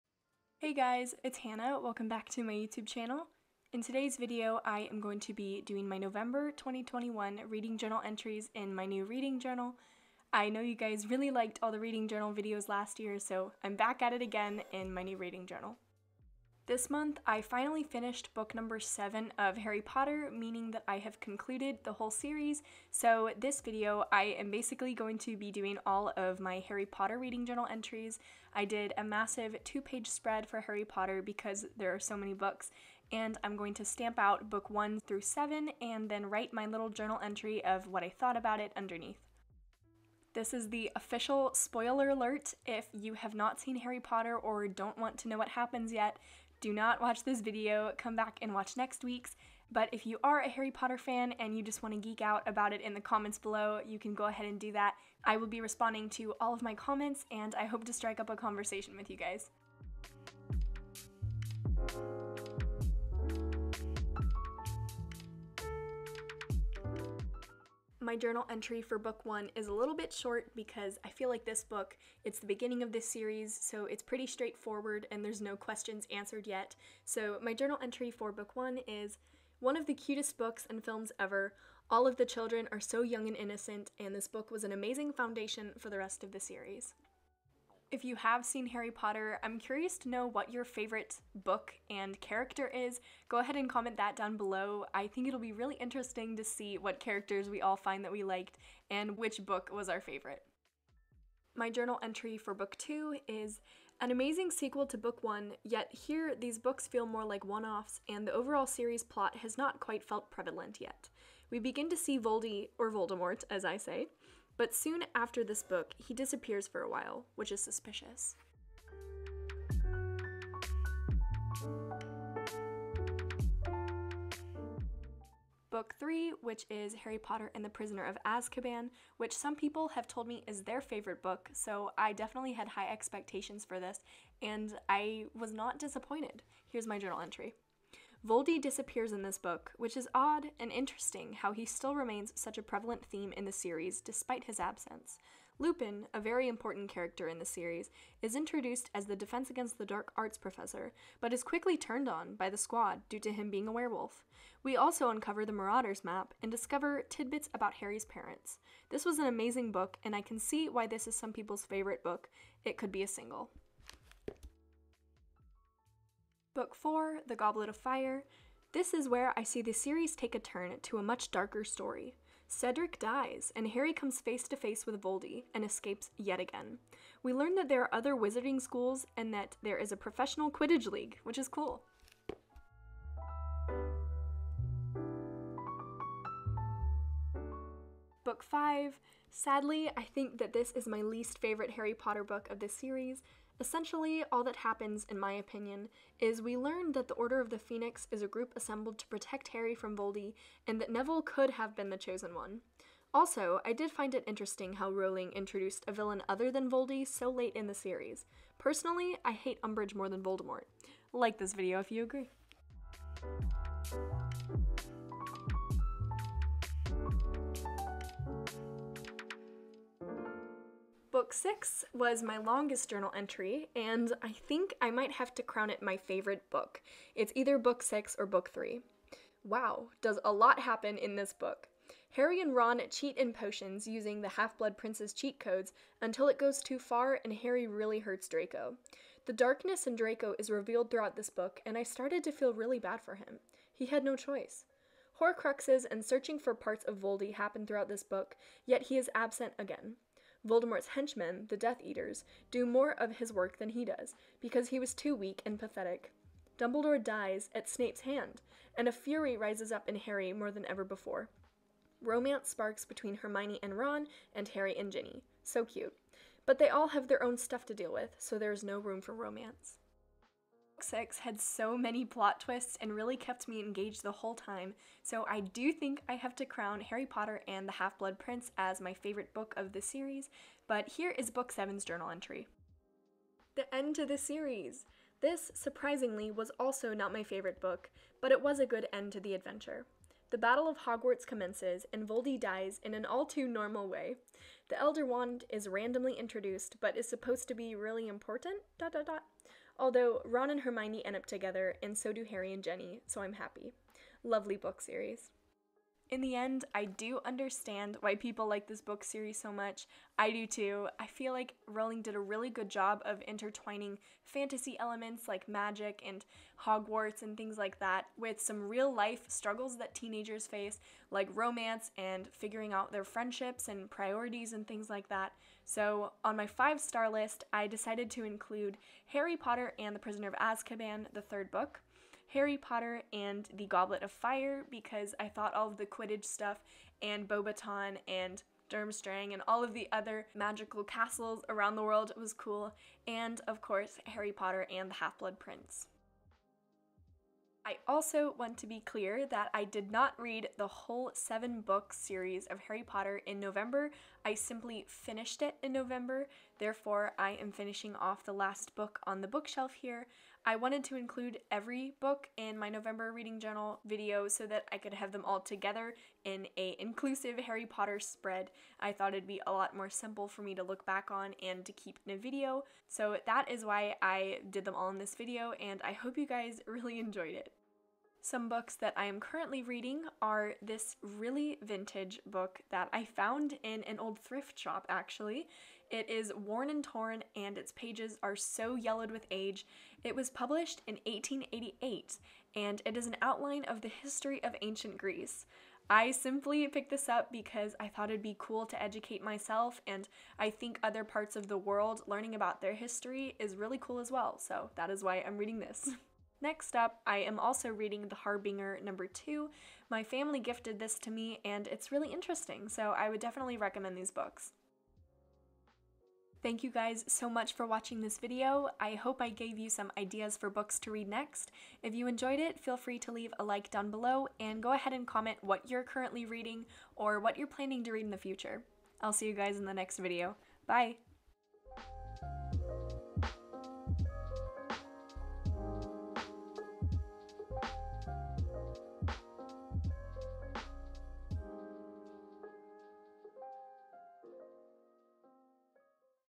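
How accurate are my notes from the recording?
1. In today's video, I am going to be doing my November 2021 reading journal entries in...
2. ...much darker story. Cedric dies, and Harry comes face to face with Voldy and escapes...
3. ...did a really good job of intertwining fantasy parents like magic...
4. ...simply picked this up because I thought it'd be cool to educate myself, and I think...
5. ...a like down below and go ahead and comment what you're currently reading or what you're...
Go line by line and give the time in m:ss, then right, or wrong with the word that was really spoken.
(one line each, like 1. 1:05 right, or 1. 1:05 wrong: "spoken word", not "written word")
1. 0:03 right
2. 2:51 right
3. 5:12 wrong: "elements", not "parents"
4. 6:36 right
5. 7:03 right.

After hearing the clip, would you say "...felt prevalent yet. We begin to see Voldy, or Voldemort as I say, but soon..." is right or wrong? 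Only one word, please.
right.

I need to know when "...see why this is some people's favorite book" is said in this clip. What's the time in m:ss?
2:40.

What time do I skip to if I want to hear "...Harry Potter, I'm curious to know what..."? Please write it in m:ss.
1:28.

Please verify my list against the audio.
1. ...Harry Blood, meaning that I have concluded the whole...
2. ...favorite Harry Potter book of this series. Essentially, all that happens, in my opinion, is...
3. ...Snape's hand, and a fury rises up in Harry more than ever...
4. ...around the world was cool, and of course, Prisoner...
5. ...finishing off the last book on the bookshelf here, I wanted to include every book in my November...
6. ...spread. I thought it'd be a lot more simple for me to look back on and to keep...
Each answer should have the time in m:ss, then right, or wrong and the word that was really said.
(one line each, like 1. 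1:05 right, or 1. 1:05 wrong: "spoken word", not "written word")
1. 0:19 wrong: "Potter", not "Blood"
2. 3:11 right
3. 4:17 right
4. 5:41 wrong: "Harry", not "Prisoner"
5. 5:57 right
6. 6:07 right.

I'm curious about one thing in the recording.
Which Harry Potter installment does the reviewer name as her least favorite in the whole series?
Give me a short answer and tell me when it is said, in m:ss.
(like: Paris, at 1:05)
Book 5, at 3:08.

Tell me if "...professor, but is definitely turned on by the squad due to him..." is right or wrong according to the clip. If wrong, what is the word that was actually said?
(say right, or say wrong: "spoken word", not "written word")
wrong: "quickly", not "definitely".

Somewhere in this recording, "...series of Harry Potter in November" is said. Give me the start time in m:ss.
5:51.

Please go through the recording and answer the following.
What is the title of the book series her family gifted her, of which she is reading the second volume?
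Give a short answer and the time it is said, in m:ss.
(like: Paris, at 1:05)
The Harbinger, at 6:48.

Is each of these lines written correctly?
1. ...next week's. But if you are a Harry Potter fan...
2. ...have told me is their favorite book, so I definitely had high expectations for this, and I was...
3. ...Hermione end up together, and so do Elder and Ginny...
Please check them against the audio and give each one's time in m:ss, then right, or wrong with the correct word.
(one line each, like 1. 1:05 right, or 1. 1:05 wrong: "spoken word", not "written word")
1. 0:48 right
2. 2:09 right
3. 5:00 wrong: "Harry", not "Elder".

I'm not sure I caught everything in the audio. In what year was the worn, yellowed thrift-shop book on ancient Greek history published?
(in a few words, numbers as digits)
1888.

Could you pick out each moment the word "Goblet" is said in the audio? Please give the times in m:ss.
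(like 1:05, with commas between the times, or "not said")
2:47, 5:33.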